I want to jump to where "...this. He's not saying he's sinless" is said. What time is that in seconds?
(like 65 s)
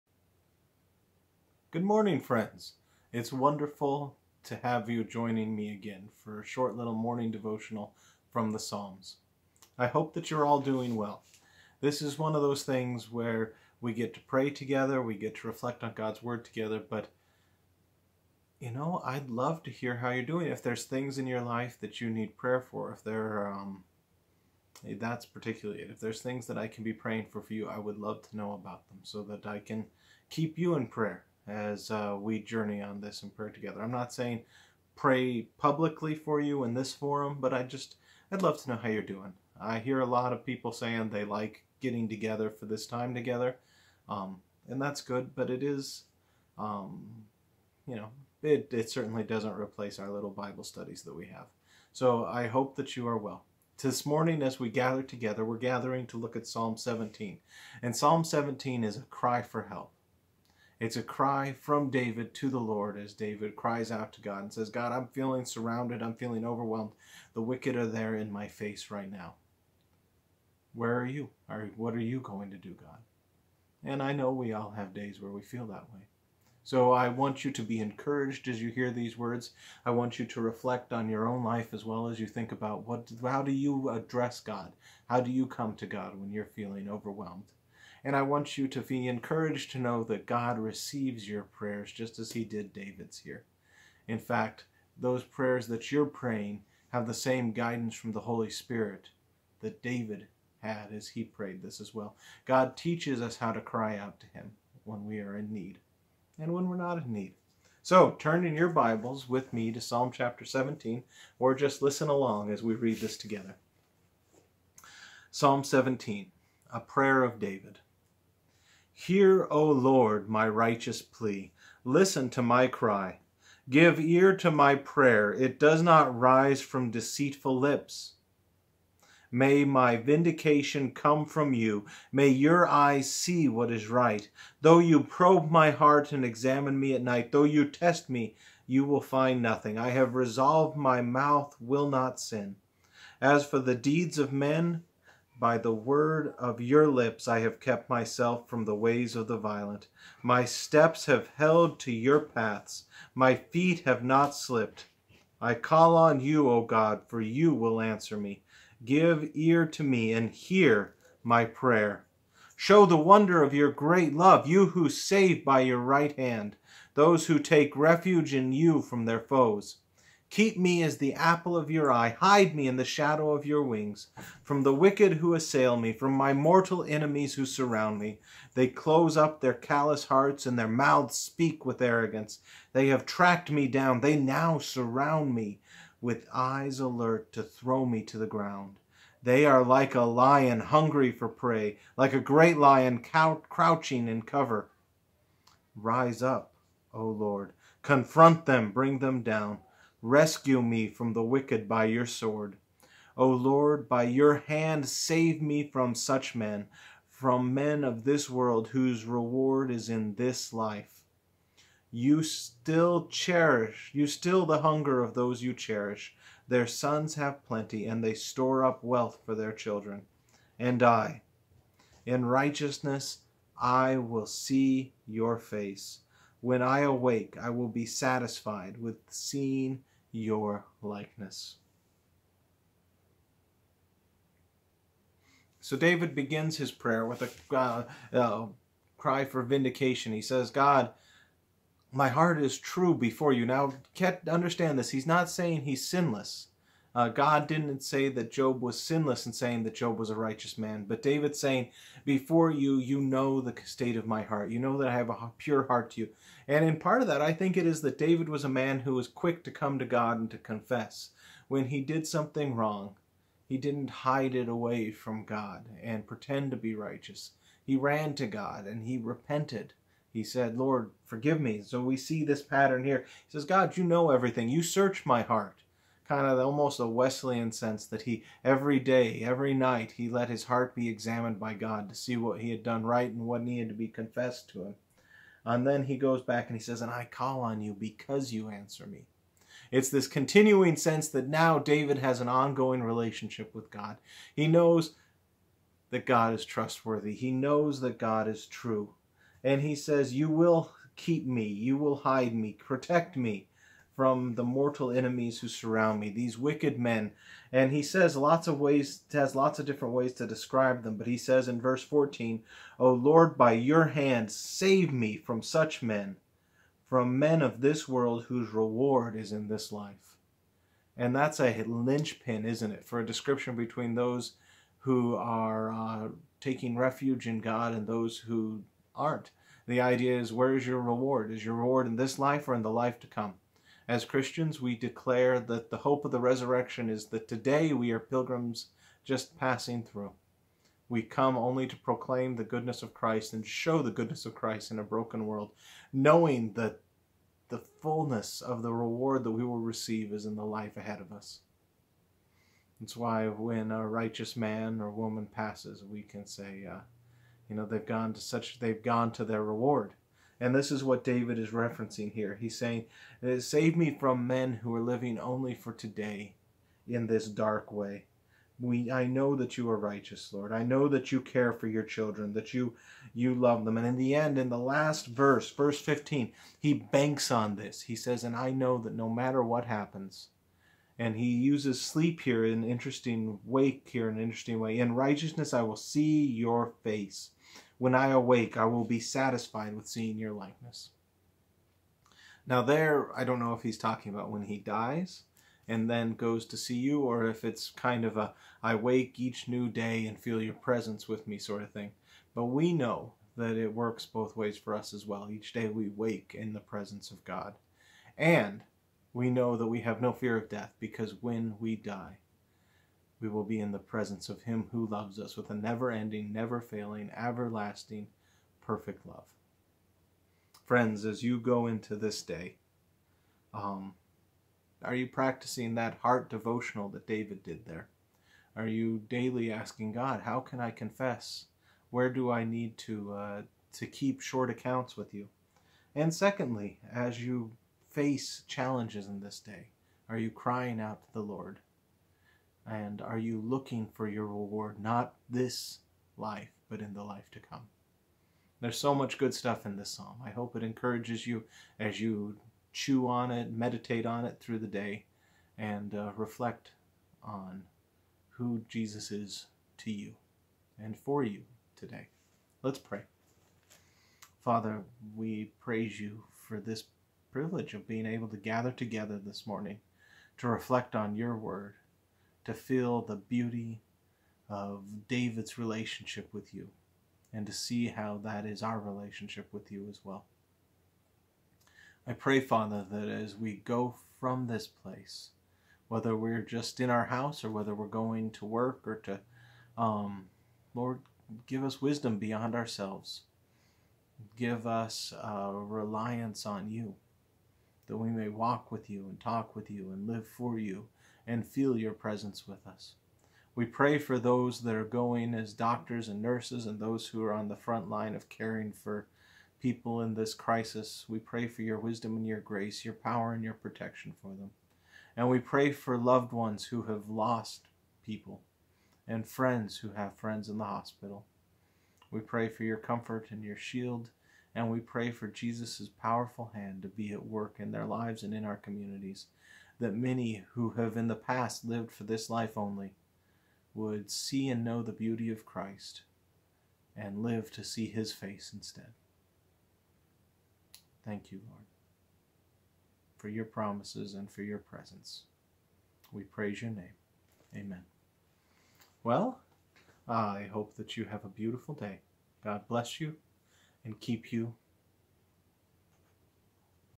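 244 s.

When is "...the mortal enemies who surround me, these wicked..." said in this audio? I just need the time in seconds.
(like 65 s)
304 s.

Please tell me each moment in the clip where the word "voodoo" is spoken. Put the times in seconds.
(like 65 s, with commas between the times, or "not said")
not said.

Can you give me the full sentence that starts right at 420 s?
Friends, as you go into this day, um, are you practicing that heart devotional that David did there?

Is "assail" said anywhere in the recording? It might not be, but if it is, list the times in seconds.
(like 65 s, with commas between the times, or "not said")
175 s.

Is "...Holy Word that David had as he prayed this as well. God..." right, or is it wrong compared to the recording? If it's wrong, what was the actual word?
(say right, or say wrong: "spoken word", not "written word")
wrong: "Spirit", not "Word".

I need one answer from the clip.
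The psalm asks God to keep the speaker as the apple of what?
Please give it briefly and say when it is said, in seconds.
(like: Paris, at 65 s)
your eye, at 171 s.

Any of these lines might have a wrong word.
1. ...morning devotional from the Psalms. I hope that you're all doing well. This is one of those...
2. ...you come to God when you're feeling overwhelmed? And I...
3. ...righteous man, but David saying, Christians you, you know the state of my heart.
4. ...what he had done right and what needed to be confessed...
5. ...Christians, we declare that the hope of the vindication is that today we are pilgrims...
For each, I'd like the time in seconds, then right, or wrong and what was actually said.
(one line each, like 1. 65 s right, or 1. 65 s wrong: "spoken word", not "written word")
1. 6 s right
2. 85 s right
3. 250 s wrong: "Before", not "Christians"
4. 282 s right
5. 334 s wrong: "resurrection", not "vindication".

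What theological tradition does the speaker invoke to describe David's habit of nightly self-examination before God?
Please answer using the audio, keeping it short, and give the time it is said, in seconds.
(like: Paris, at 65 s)
Wesleyan, at 276 s.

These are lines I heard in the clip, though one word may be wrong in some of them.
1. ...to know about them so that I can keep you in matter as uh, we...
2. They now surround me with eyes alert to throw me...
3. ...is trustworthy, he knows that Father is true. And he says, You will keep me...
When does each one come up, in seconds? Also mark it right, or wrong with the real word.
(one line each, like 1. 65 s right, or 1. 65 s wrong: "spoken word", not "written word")
1. 28 s wrong: "prayer", not "matter"
2. 183 s right
3. 296 s wrong: "God", not "Father".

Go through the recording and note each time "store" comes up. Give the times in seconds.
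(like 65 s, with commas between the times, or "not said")
218 s.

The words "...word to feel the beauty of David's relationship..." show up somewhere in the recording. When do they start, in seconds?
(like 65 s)
471 s.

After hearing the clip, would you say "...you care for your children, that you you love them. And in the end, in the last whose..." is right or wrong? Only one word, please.
wrong.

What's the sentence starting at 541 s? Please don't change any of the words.
Thank you, Lord, for your promises and for your presence.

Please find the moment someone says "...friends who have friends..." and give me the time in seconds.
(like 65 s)
519 s.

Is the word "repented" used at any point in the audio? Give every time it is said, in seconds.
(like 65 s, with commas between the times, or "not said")
268 s.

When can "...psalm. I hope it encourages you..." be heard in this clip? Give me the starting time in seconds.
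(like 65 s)
449 s.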